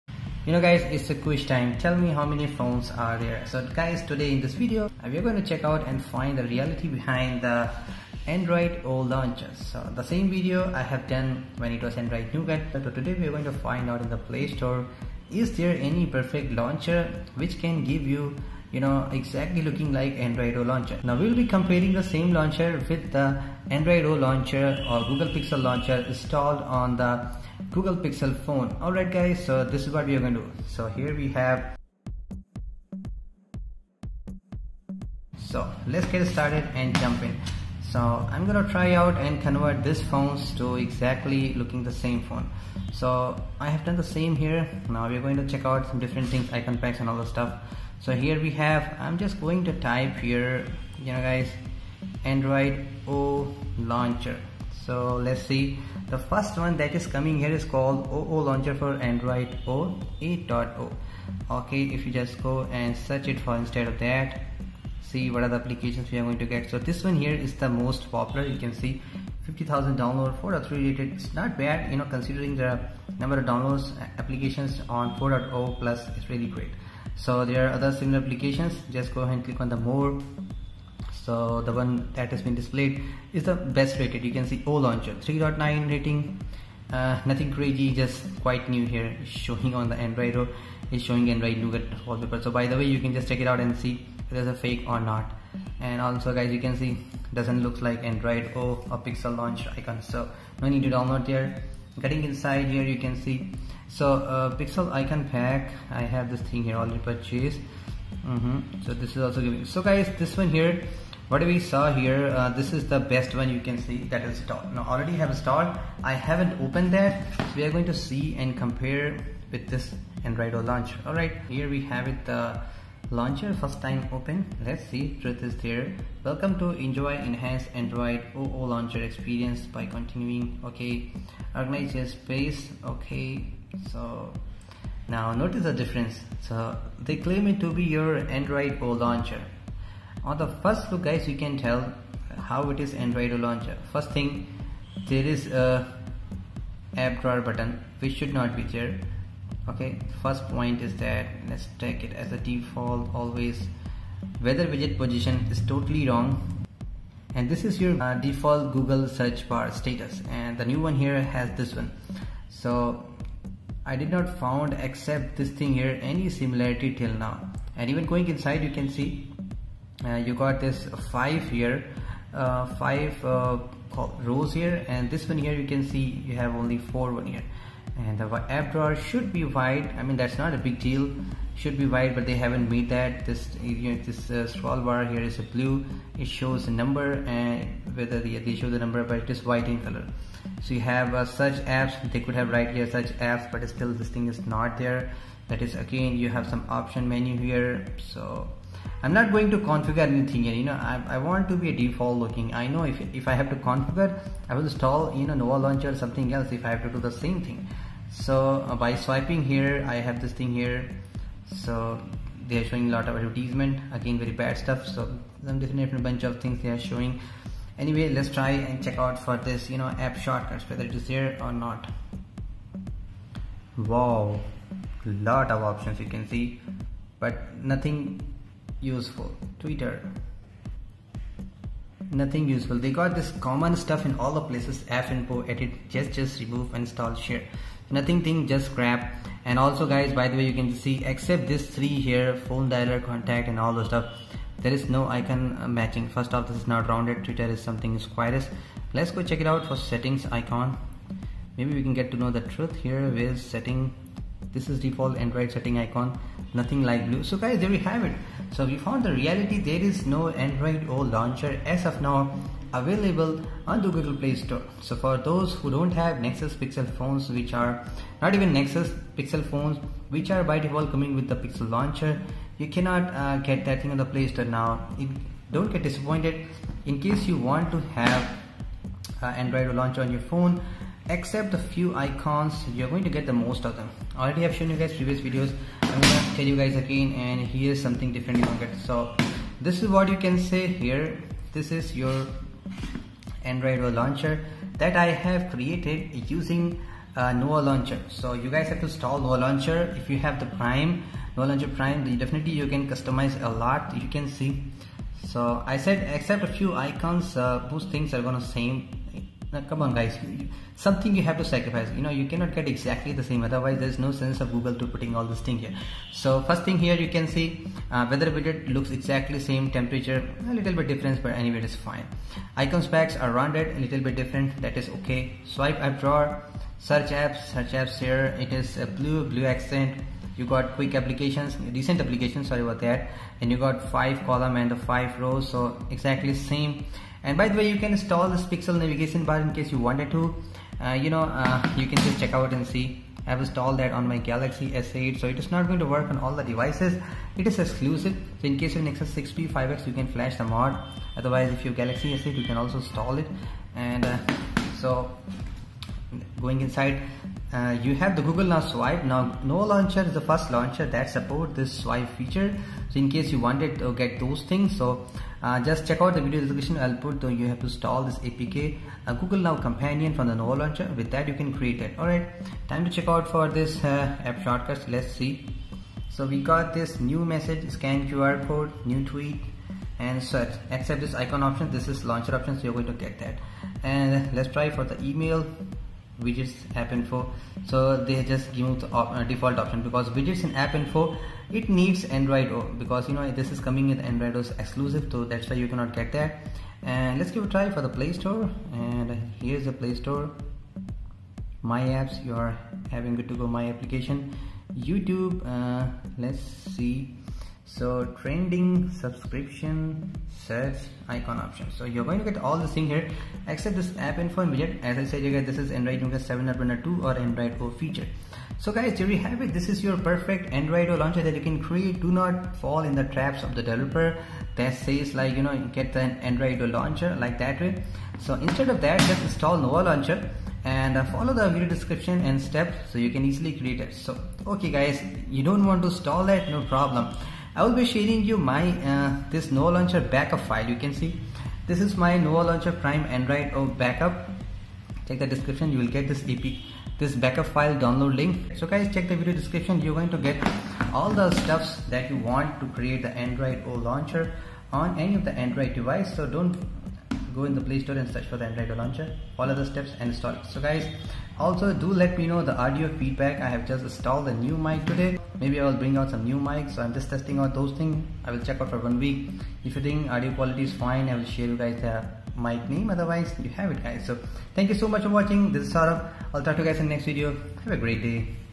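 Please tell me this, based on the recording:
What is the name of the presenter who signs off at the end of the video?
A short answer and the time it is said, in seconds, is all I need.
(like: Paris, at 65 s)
Saurabh, at 475 s.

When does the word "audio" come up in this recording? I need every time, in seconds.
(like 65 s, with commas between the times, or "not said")
462 s, 470 s.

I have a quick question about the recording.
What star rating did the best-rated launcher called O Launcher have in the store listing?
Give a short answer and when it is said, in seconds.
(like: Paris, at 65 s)
3.9, at 85 s.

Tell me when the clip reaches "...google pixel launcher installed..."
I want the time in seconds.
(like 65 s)
25 s.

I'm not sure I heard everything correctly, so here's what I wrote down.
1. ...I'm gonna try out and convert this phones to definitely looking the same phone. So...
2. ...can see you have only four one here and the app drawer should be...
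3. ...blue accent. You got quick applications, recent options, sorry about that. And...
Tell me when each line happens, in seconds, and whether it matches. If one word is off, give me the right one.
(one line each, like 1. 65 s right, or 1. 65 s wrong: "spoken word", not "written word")
1. 38 s wrong: "exactly", not "definitely"
2. 175 s right
3. 329 s wrong: "applications", not "options".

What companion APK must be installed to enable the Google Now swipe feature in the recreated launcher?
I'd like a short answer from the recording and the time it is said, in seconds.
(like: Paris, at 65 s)
Google Now Companion, at 369 s.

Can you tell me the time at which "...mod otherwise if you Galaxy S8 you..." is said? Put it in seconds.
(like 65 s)
350 s.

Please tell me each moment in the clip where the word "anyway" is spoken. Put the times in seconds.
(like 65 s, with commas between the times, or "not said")
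217 s, 321 s.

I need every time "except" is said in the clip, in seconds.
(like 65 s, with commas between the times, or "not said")
164 s, 241 s, 281 s, 306 s, 413 s.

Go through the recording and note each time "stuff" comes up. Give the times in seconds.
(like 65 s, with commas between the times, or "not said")
47 s, 214 s, 233 s, 243 s, 451 s.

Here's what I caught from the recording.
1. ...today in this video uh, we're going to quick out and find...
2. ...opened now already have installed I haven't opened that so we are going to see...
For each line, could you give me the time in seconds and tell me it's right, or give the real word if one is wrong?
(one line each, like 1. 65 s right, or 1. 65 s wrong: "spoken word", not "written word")
1. 4 s wrong: "check", not "quick"
2. 114 s wrong: "installed", not "opened".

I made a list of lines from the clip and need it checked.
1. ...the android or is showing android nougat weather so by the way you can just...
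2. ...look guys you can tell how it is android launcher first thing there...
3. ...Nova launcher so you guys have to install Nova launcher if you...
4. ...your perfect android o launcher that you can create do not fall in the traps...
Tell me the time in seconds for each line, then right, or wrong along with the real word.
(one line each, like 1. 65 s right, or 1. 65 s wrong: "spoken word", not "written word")
1. 89 s wrong: "wallpaper", not "weather"
2. 140 s right
3. 297 s right
4. 419 s right.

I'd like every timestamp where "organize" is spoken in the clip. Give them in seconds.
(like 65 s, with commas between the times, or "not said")
131 s.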